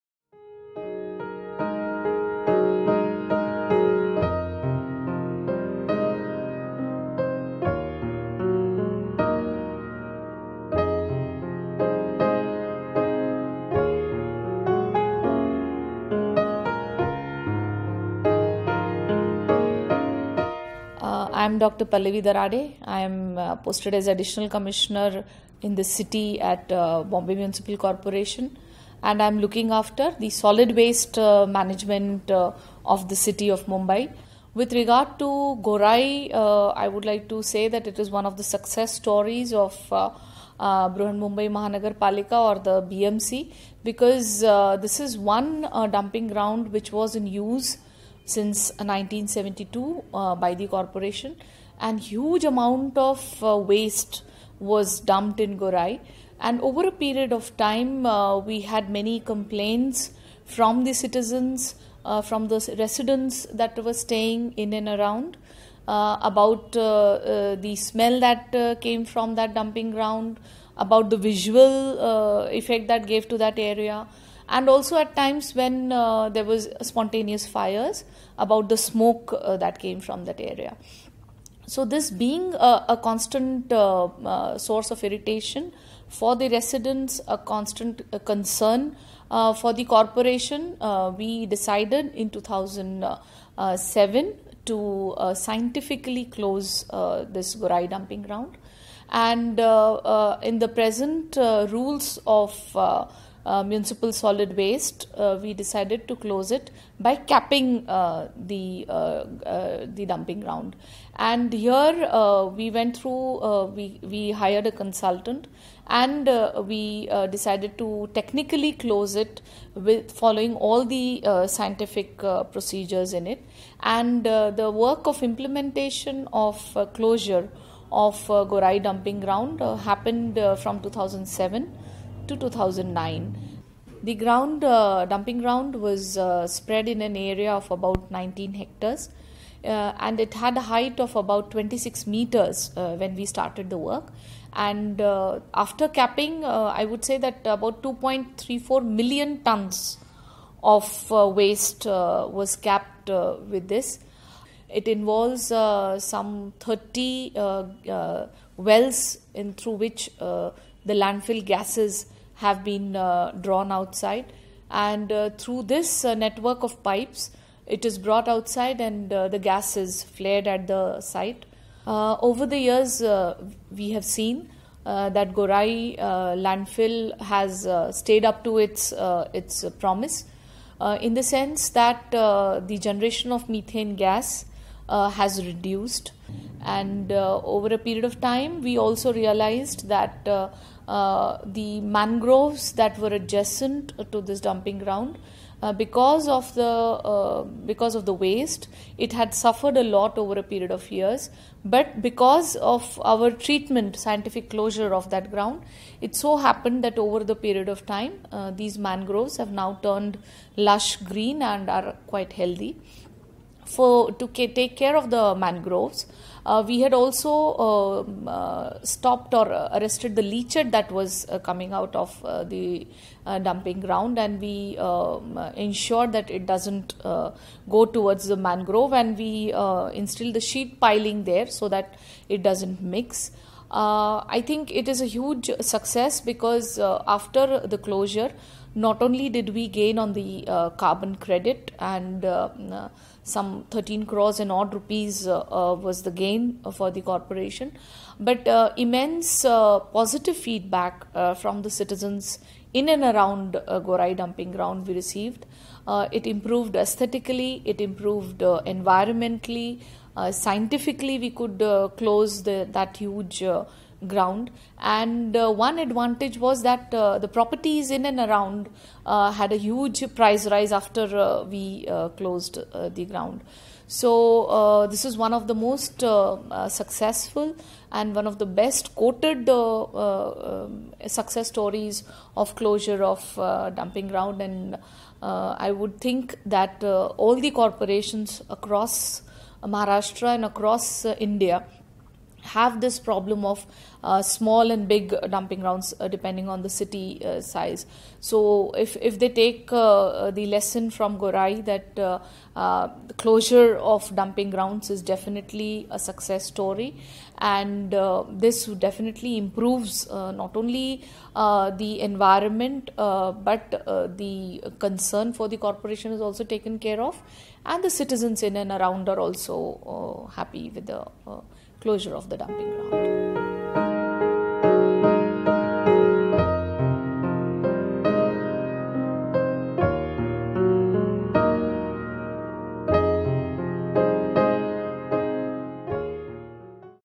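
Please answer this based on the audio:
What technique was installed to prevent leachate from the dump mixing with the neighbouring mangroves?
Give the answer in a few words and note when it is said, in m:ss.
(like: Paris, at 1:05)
sheet piling, at 3:50.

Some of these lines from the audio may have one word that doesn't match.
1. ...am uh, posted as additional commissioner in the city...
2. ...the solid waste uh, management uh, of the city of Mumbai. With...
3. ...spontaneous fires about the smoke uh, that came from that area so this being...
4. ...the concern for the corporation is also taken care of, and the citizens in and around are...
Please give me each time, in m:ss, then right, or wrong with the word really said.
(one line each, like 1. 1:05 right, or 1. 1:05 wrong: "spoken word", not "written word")
1. 0:23 right
2. 0:30 right
3. 1:16 right
4. 5:14 right.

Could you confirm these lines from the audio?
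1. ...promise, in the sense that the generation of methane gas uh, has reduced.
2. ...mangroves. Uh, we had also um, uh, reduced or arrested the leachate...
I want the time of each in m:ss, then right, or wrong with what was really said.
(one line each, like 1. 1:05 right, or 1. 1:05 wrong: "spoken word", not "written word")
1. 2:59 right
2. 3:35 wrong: "stopped", not "reduced".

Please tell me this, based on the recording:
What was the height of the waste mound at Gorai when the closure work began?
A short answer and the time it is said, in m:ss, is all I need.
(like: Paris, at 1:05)
26 meters, at 2:21.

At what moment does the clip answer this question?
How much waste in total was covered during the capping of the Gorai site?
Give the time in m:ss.
2:27.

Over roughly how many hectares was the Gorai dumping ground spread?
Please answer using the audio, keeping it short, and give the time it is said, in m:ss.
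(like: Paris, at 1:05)
19 hectares, at 2:18.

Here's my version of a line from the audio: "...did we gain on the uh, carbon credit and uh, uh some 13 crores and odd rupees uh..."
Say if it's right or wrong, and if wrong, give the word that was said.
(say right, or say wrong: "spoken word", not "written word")
right.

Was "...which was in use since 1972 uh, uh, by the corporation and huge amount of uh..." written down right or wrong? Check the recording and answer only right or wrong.
right.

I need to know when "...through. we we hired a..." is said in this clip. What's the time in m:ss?
1:52.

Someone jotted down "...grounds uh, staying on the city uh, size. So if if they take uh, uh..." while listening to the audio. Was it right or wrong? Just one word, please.
wrong.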